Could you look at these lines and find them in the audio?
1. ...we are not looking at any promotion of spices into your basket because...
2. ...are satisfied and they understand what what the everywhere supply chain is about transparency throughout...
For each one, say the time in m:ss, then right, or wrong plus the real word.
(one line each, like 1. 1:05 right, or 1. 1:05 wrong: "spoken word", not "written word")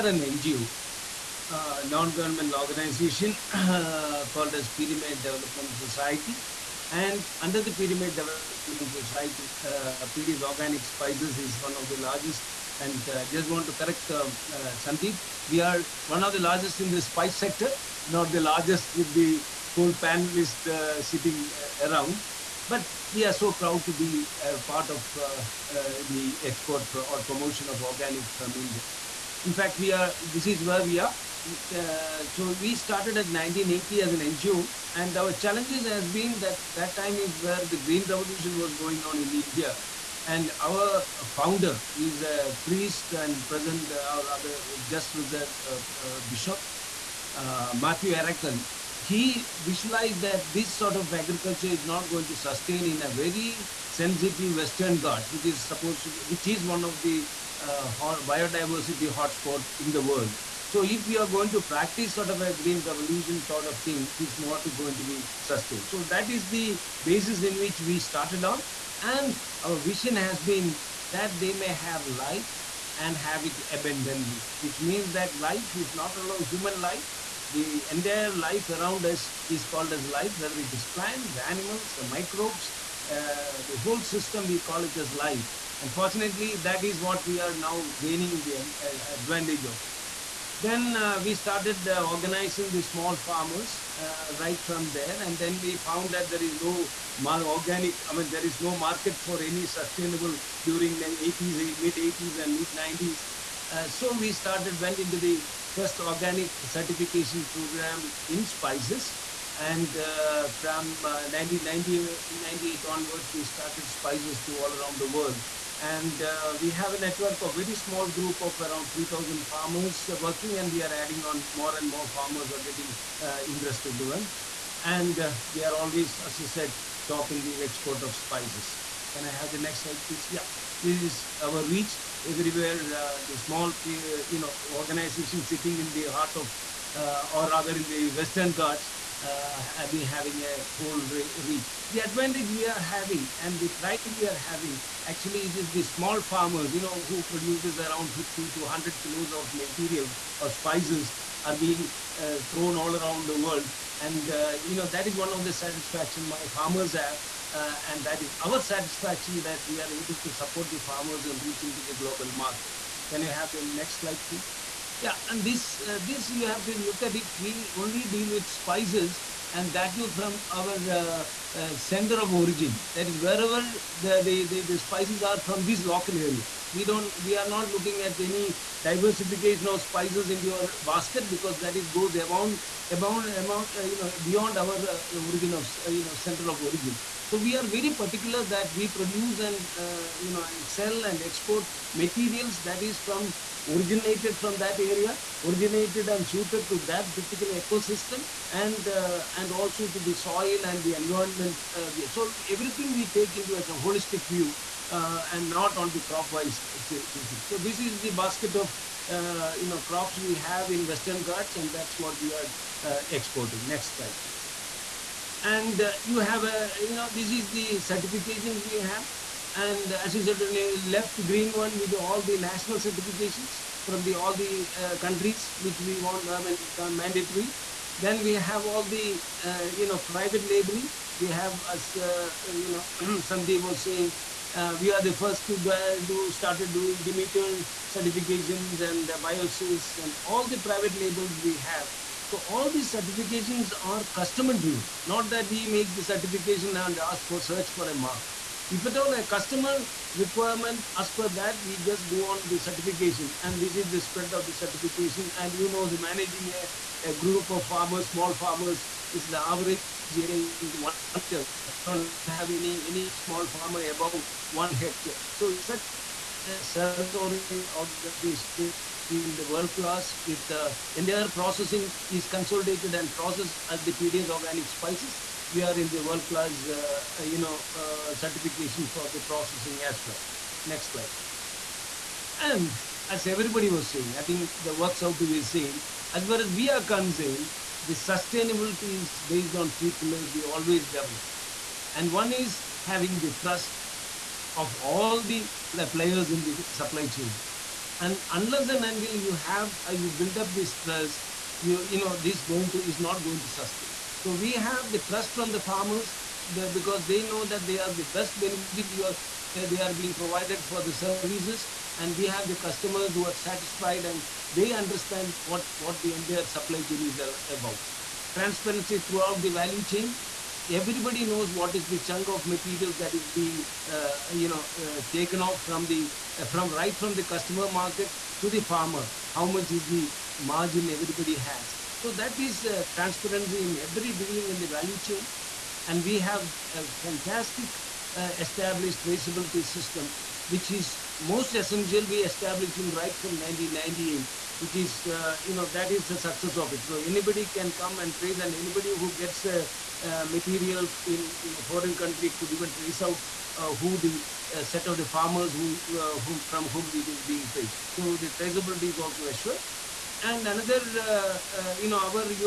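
1. 2:57 wrong: "diversification", not "promotion"
2. 5:13 wrong: "entire", not "everywhere".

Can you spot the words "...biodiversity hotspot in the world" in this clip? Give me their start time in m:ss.
0:57.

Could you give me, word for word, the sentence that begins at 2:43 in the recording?
Can you have the next slide, please?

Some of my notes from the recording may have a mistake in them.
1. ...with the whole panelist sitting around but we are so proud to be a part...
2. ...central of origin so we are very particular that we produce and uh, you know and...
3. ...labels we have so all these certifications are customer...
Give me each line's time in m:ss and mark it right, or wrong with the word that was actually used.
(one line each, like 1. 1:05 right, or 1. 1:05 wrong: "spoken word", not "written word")
1. 0:18 right
2. 3:06 right
3. 4:01 right.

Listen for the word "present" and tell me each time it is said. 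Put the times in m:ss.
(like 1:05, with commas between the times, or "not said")
0:43.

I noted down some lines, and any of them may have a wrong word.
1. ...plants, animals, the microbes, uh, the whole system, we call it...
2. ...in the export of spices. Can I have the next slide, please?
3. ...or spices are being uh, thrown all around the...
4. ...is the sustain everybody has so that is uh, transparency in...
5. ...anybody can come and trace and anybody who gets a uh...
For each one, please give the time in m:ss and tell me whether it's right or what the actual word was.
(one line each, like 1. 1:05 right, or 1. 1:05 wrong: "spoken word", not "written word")
1. 1:20 right
2. 2:07 right
3. 2:30 right
4. 5:29 wrong: "margin", not "sustain"
5. 5:46 right.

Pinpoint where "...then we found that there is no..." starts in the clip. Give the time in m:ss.
1:35.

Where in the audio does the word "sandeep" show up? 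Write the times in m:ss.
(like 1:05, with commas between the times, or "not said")
0:14, 3:53.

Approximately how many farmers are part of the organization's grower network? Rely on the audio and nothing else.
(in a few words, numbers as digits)
3,000.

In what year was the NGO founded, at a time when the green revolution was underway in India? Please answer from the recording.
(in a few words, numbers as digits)
1980.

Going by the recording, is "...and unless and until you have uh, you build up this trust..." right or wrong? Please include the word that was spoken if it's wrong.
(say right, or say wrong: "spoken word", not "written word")
right.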